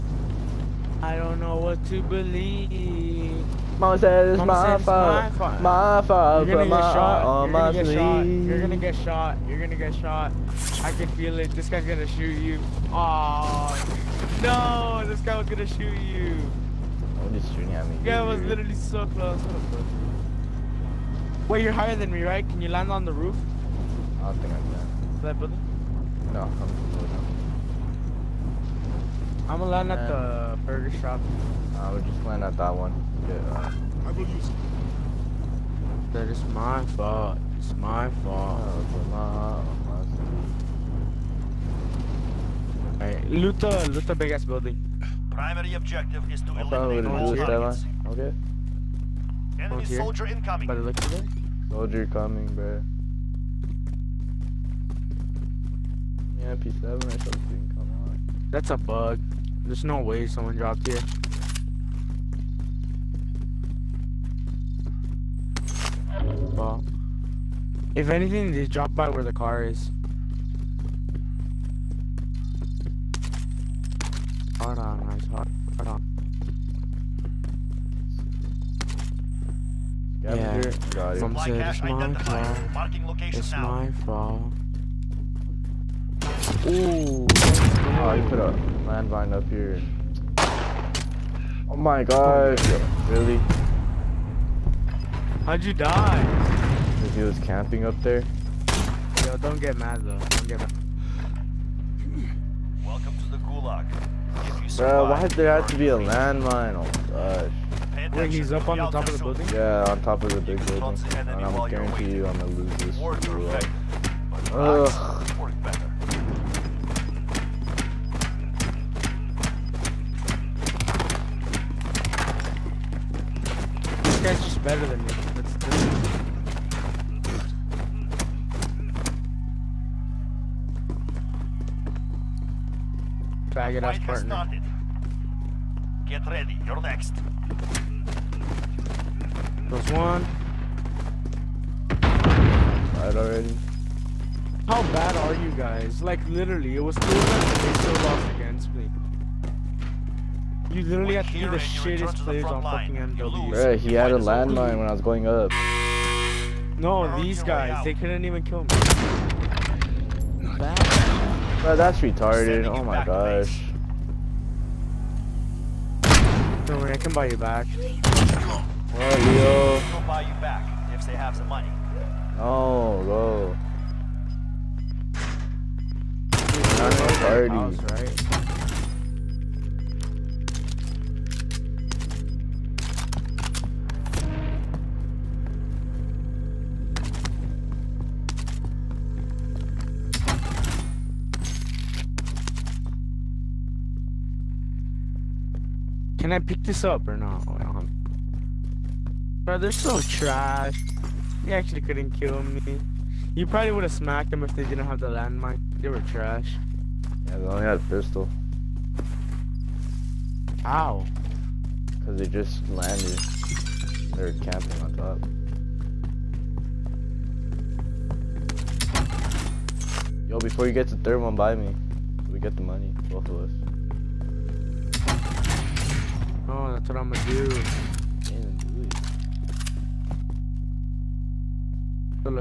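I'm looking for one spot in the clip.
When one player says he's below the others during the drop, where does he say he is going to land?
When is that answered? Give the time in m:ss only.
0:30.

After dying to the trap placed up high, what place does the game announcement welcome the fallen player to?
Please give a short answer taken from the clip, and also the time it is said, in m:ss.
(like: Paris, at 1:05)
gulag, at 1:43.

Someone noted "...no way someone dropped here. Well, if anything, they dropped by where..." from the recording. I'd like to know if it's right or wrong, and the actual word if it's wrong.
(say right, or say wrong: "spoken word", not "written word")
right.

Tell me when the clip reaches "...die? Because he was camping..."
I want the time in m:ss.
1:35.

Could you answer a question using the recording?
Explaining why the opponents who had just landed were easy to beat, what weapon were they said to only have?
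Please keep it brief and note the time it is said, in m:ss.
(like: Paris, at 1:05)
a pistol, at 3:27.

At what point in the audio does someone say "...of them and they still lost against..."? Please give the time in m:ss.
2:27.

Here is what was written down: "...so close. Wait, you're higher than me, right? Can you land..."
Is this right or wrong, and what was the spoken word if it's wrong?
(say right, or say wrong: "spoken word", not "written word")
right.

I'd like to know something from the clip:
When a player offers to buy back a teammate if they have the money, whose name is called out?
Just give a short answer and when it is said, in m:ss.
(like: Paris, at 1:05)
Leo, at 2:49.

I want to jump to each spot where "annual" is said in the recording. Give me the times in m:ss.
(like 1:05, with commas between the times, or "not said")
not said.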